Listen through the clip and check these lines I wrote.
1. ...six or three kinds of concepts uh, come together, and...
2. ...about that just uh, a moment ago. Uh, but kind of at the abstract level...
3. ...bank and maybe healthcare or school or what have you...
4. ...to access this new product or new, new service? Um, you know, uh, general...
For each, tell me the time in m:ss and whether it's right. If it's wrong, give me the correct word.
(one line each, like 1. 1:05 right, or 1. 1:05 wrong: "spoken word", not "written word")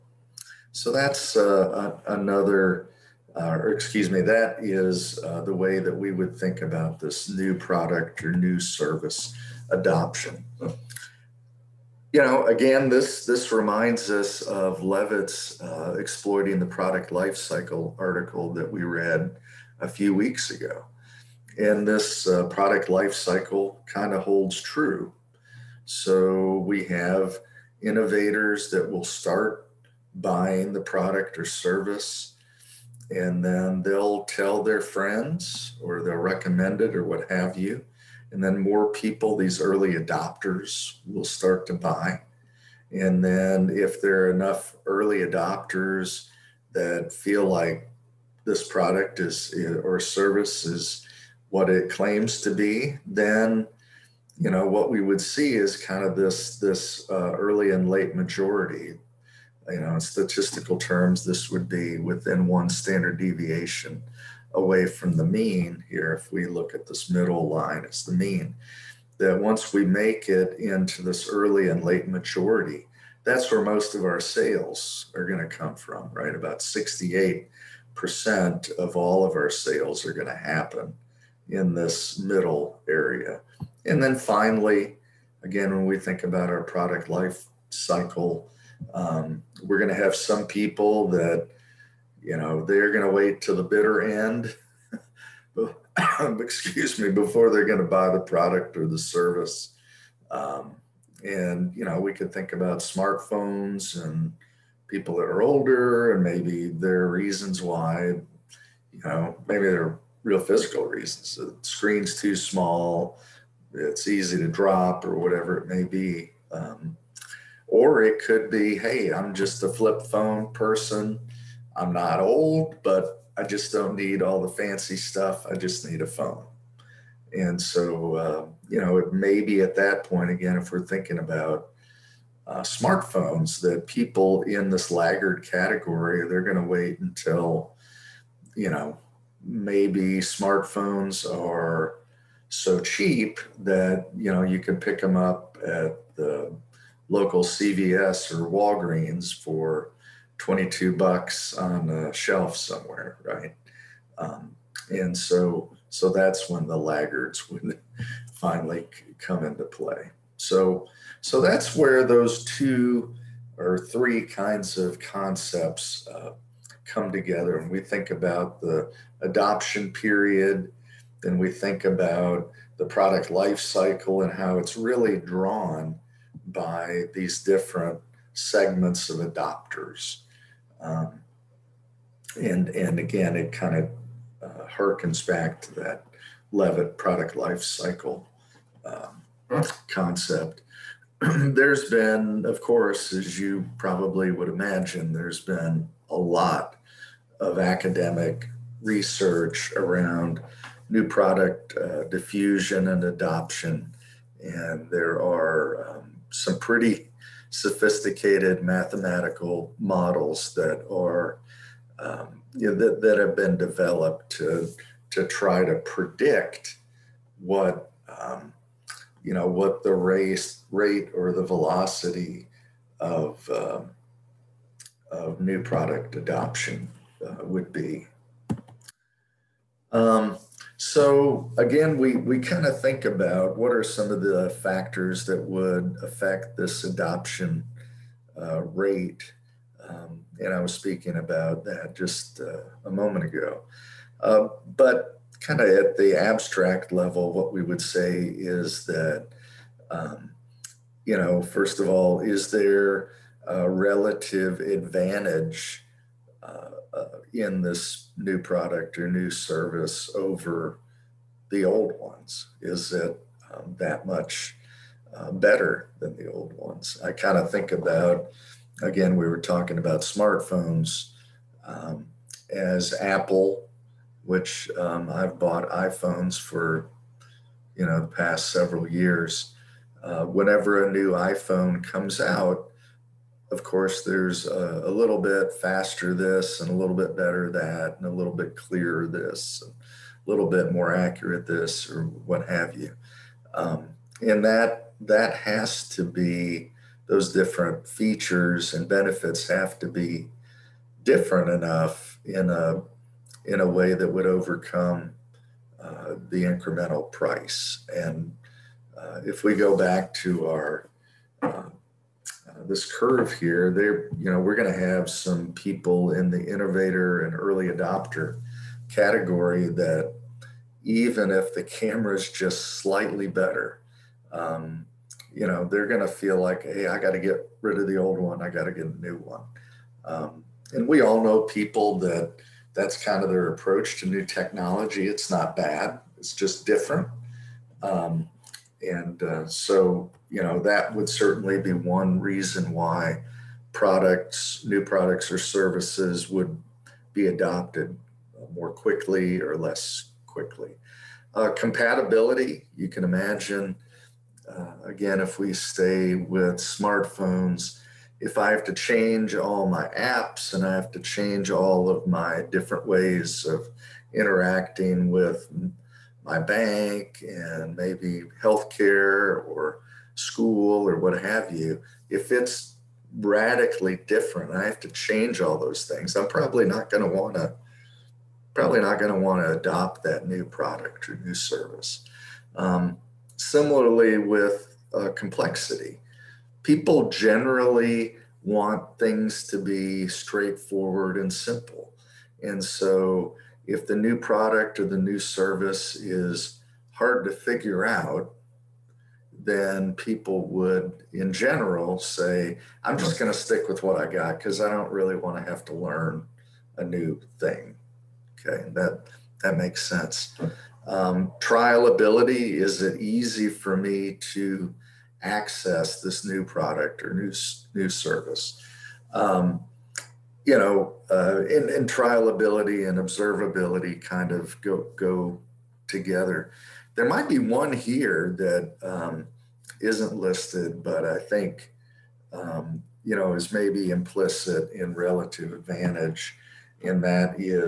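1. 2:42 wrong: "two", not "six"
2. 4:01 right
3. 6:06 right
4. 6:54 wrong: "trial", not "general".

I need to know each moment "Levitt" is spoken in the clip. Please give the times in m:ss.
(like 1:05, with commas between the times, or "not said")
0:14, 3:06.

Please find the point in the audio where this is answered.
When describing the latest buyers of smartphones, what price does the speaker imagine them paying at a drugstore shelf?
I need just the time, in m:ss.
2:30.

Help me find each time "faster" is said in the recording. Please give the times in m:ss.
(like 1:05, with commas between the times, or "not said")
4:45.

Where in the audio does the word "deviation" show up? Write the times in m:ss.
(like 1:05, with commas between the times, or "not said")
1:03.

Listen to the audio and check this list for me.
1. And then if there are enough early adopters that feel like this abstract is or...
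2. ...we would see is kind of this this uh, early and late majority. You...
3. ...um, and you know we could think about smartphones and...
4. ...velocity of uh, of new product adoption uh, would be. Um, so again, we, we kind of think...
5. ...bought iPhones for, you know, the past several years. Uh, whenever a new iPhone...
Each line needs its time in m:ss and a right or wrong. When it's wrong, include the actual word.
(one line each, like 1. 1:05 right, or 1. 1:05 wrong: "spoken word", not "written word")
1. 0:42 wrong: "product", not "abstract"
2. 0:54 right
3. 1:40 right
4. 3:41 right
5. 4:35 right.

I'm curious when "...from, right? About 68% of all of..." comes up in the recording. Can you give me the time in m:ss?
1:15.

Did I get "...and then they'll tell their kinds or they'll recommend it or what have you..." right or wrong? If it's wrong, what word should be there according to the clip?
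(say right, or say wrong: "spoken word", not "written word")
wrong: "friends", not "kinds".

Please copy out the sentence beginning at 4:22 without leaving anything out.
Is it um, that much uh, better than the old ones?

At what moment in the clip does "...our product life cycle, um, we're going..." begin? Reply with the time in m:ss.
1:26.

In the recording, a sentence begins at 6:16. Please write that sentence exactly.
I'm probably not going to want to probably not going to want to adopt that new product or new service.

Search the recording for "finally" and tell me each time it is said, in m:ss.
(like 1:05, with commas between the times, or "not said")
1:24, 2:38.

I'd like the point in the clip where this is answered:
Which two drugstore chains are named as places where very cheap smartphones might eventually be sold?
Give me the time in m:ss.
2:27.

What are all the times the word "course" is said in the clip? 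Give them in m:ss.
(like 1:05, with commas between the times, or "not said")
3:12, 4:43.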